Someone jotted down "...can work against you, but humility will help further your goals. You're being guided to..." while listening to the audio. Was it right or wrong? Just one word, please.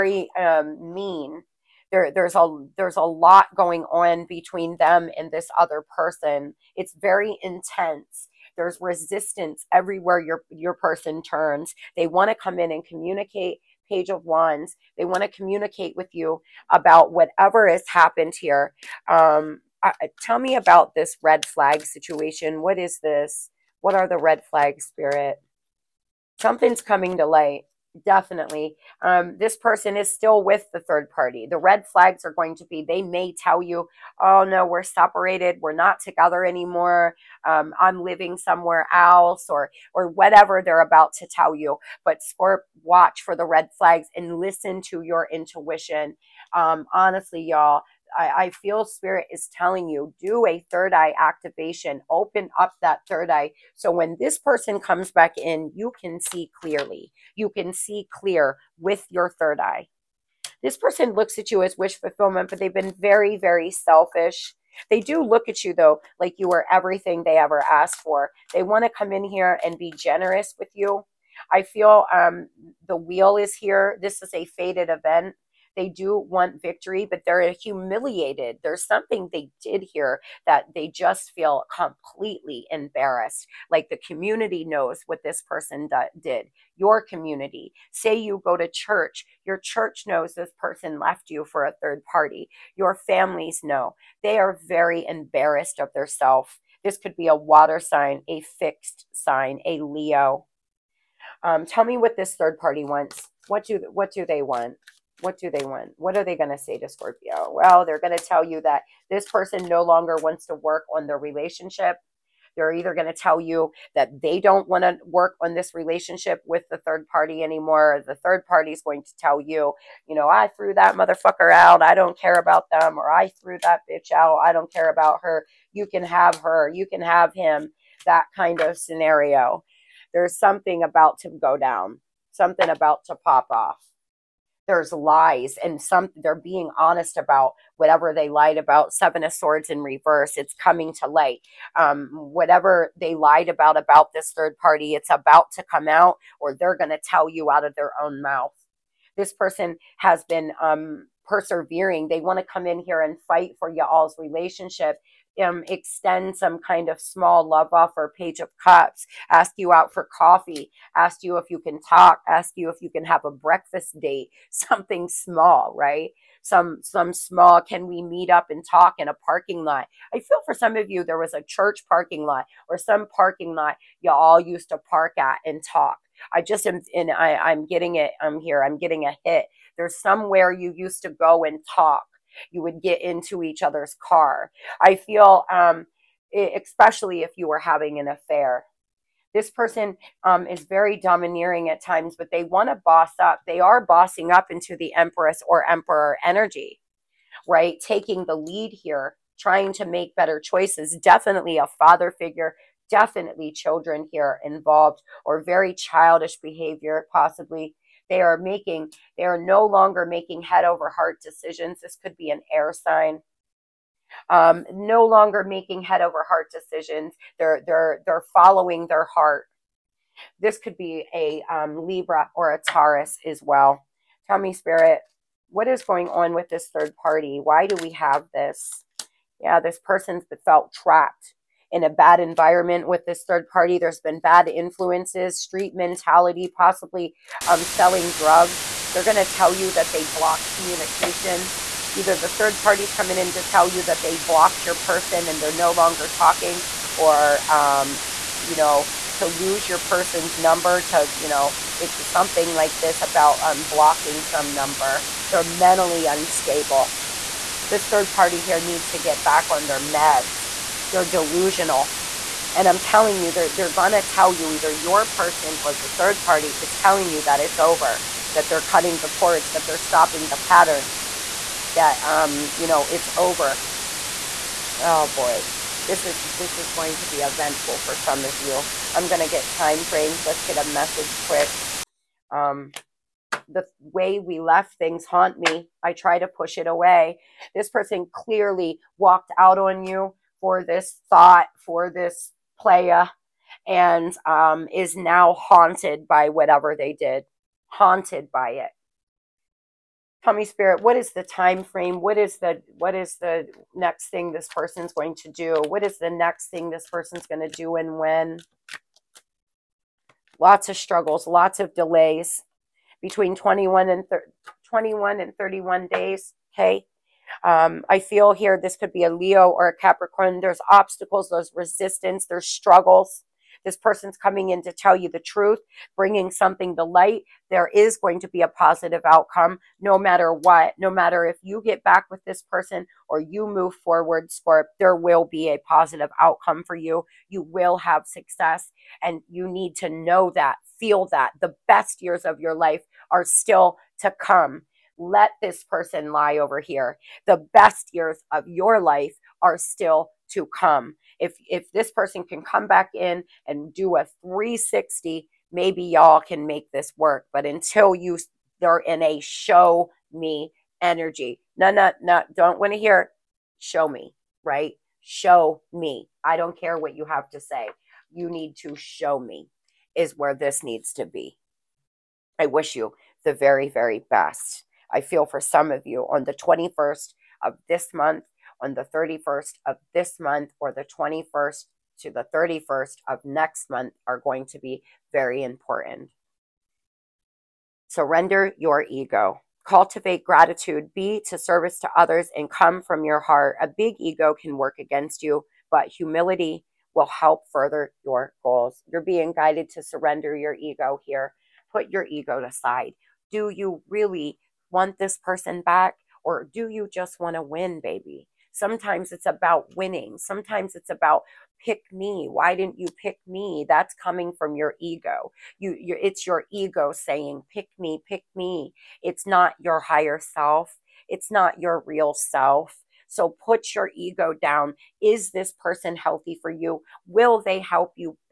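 right.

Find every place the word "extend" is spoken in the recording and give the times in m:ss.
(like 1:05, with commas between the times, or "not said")
2:35.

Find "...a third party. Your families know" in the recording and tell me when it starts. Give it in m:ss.
1:31.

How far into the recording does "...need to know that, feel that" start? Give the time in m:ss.
5:39.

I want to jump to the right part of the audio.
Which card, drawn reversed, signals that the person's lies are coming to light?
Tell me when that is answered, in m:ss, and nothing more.
2:18.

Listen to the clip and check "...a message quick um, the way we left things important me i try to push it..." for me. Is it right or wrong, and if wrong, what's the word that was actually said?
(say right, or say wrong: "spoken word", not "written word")
wrong: "haunt", not "important".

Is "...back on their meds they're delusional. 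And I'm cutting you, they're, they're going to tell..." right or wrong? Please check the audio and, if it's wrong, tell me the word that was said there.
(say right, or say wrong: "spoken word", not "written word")
wrong: "telling", not "cutting".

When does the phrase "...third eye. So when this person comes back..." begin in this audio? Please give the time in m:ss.
0:53.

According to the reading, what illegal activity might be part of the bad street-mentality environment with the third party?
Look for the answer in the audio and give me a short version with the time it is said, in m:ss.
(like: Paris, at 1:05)
Selling drugs, at 3:57.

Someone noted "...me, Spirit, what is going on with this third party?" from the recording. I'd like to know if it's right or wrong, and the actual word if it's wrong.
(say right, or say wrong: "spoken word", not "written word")
right.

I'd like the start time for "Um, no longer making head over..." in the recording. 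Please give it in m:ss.
3:34.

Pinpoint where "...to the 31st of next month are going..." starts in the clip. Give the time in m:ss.
6:21.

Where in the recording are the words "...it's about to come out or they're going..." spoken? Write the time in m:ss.
2:24.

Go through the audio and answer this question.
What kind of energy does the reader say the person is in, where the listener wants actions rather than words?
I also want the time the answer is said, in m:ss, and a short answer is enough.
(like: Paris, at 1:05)
Show me energy, at 5:59.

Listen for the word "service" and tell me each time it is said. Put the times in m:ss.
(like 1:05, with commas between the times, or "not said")
6:31.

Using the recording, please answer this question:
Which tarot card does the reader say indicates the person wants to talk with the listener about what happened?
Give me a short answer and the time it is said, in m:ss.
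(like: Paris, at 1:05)
Page of Wands, at 0:13.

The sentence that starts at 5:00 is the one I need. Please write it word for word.
Tummy spirit, what is the time frame?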